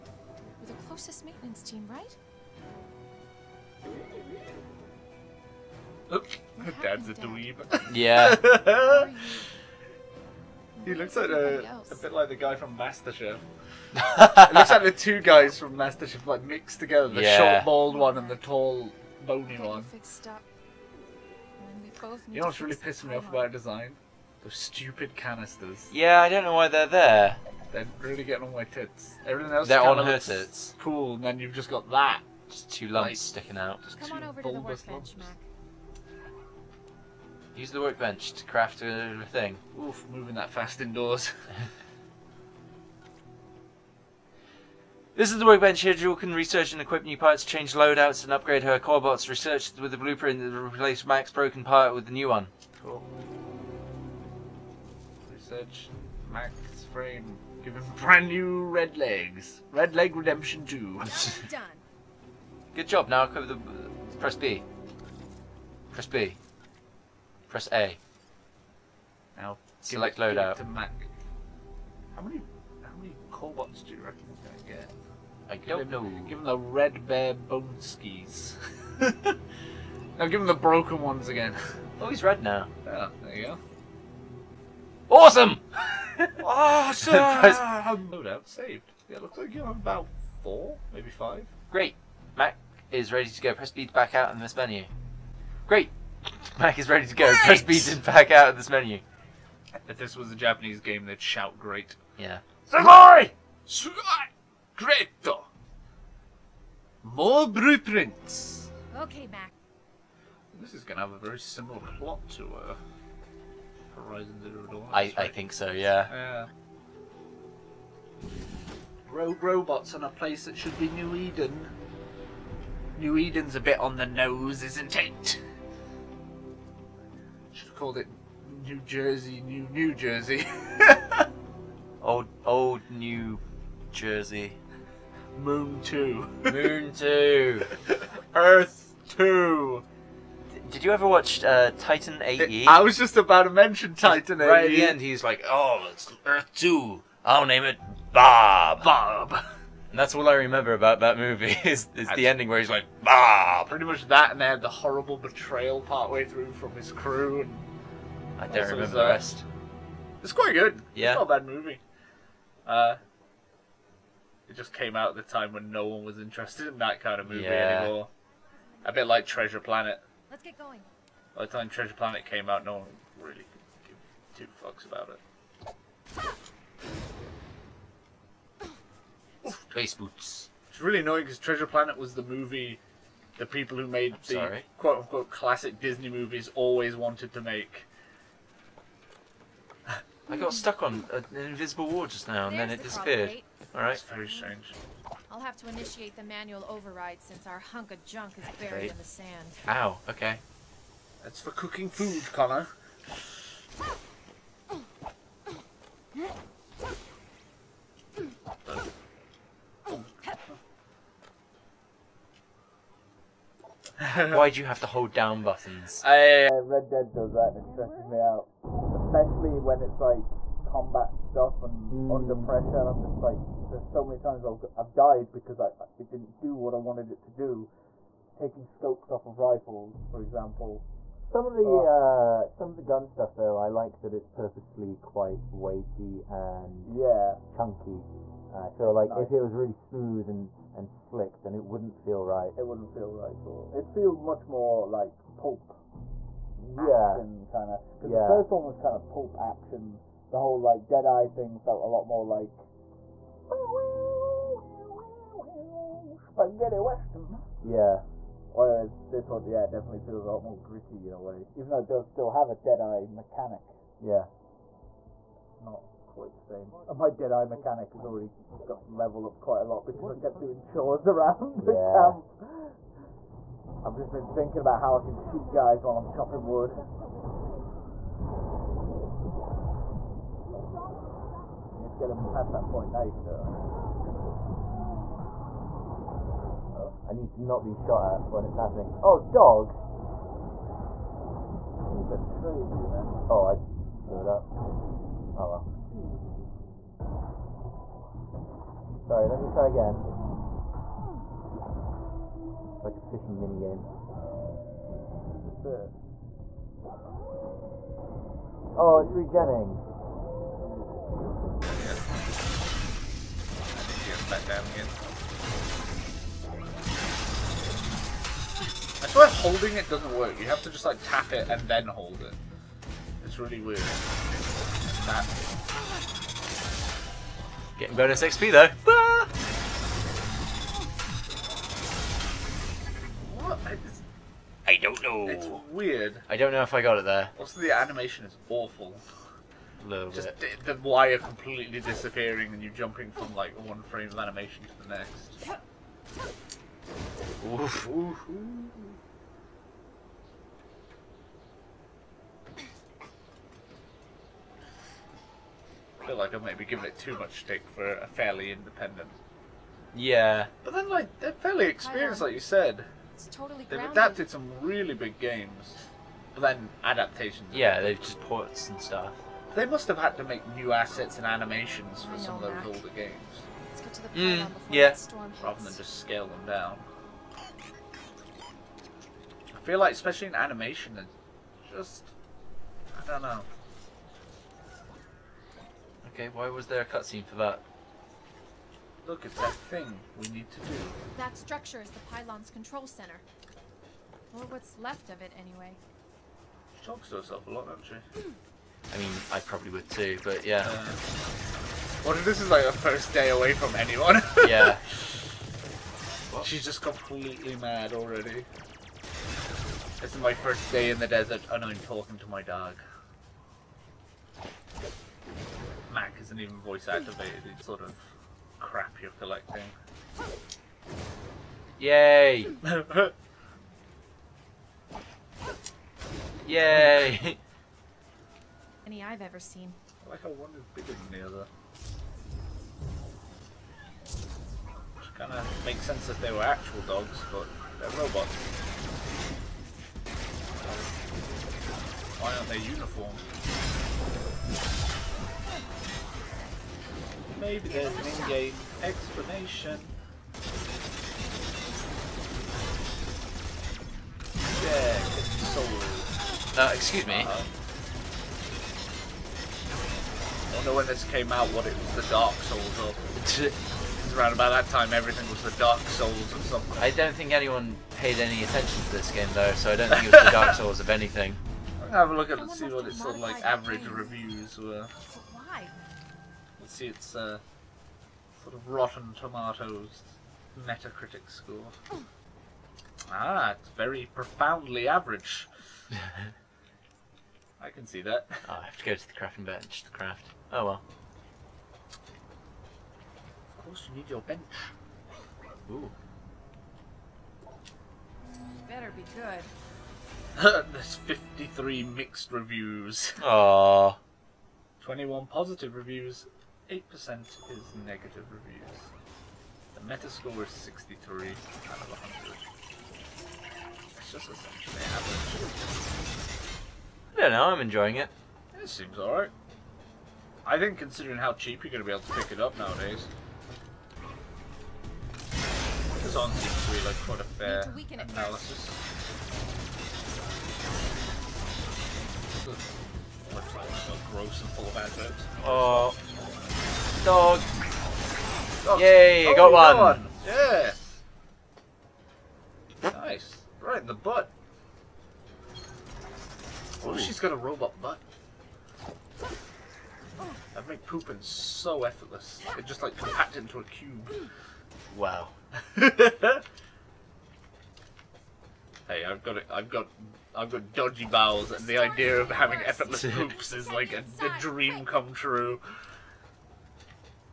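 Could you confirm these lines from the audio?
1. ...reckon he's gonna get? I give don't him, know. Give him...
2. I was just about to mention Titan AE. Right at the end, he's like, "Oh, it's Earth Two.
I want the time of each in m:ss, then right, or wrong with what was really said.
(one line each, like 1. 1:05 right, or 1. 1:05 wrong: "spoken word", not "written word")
1. 1:14 right
2. 2:22 right.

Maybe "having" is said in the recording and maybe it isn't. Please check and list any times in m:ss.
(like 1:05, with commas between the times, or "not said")
9:22.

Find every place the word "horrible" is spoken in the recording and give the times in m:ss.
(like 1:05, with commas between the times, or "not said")
2:34.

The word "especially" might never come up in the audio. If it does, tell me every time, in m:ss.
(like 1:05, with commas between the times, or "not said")
3:38, 6:19.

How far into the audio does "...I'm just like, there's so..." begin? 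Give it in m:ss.
3:42.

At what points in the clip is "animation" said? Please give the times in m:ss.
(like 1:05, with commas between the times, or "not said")
5:37, 5:44, 6:11, 6:20.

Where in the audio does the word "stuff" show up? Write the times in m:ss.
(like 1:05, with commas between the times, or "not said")
3:41, 3:53, 6:08.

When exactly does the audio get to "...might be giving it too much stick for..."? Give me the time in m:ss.
5:56.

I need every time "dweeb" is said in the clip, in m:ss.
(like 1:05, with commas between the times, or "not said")
0:07.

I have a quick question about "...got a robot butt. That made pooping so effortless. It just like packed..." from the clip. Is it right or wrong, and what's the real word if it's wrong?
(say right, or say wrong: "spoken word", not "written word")
right.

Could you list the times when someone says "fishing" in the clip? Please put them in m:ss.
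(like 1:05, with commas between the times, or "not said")
5:02.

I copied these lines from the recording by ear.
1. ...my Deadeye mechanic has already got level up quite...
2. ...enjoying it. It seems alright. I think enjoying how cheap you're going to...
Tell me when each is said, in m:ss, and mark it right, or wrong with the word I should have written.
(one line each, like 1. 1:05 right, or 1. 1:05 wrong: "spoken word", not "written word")
1. 4:26 right
2. 8:37 wrong: "considering", not "enjoying".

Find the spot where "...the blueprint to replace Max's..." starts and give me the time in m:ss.
0:49.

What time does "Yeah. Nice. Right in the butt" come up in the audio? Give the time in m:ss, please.
9:00.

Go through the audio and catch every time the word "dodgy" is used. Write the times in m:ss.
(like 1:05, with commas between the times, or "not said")
9:20.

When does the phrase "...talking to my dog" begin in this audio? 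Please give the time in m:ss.
6:51.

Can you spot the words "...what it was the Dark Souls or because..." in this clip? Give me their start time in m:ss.
7:41.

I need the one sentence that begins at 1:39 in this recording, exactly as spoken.
If this was a Japanese game, they'd shout great.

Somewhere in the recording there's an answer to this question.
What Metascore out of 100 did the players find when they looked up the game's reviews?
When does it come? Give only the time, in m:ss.
8:30.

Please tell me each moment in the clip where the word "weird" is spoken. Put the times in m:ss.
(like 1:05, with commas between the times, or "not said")
5:23, 5:35.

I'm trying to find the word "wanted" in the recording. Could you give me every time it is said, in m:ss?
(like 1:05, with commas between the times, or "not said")
3:06, 3:46.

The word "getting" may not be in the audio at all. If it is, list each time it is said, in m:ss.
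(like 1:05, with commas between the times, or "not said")
0:28, 5:27.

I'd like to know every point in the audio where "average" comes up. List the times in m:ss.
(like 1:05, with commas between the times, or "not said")
7:53, 8:04, 8:35.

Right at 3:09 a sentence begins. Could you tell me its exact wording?
I got stuck on an uh, invisible wall just now and There's then it the disappeared.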